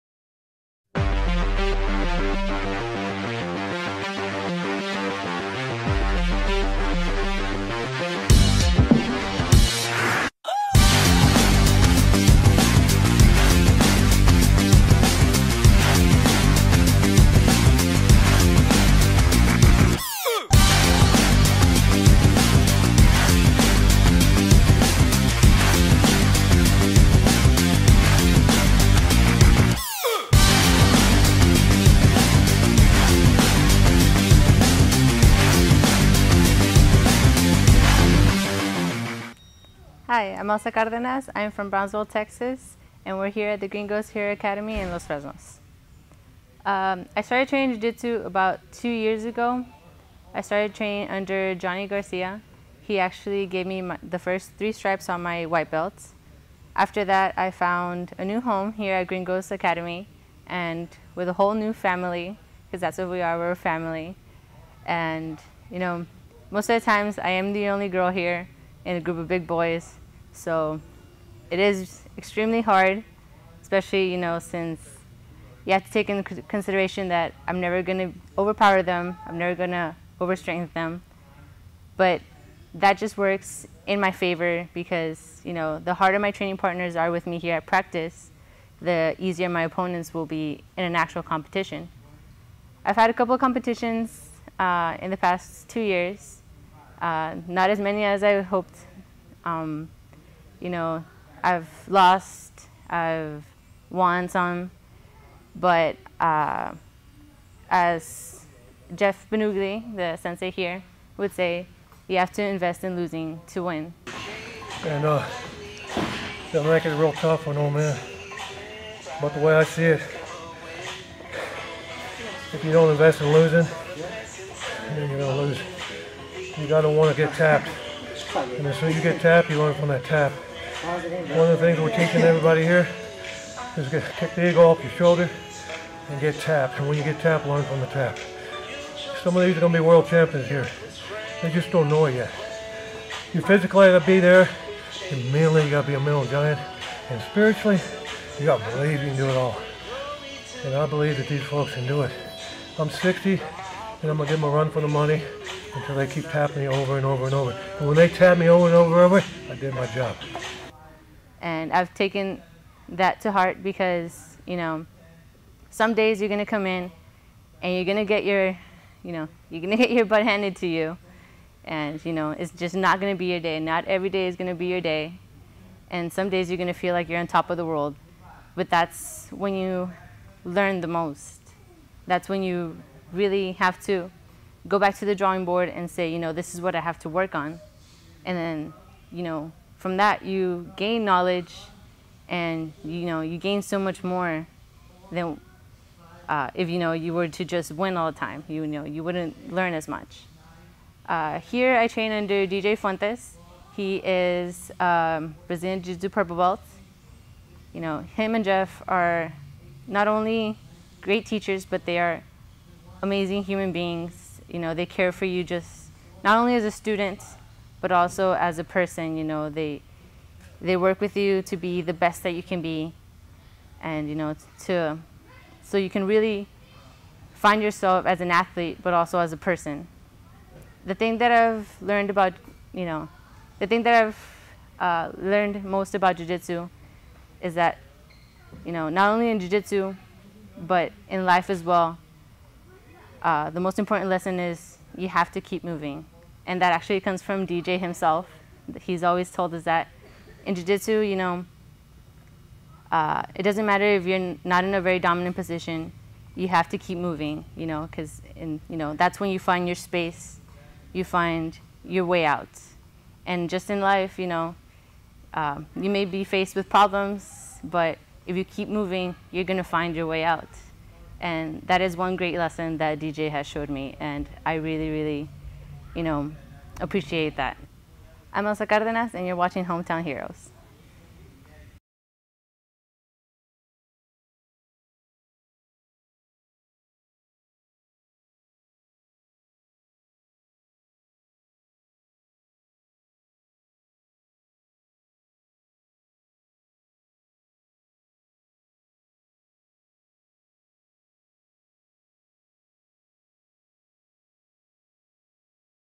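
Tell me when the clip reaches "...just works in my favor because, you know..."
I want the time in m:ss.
1:22.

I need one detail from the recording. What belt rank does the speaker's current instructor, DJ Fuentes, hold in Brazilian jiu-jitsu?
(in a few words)
purple belt.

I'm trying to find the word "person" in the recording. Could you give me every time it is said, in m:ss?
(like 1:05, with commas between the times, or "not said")
3:38, 3:49.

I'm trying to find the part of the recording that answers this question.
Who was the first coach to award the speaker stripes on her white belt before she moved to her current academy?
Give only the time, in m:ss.
0:51.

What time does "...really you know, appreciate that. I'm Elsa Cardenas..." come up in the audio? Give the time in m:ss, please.
4:34.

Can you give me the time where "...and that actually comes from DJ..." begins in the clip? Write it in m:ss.
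4:06.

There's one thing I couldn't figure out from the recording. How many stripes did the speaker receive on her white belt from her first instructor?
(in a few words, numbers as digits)
3.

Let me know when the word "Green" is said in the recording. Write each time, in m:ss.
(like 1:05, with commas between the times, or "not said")
0:43, 0:59.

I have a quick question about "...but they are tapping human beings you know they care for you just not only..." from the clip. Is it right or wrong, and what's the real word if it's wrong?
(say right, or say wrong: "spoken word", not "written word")
wrong: "amazing", not "tapping".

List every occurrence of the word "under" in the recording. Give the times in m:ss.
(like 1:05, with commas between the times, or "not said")
0:51, 3:22.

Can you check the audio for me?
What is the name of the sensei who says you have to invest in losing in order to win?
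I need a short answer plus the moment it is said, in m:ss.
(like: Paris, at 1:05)
Jeff Bonugli, at 1:48.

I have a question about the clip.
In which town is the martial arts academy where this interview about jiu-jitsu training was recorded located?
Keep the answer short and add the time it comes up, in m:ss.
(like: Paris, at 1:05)
Los Fresnos, at 0:44.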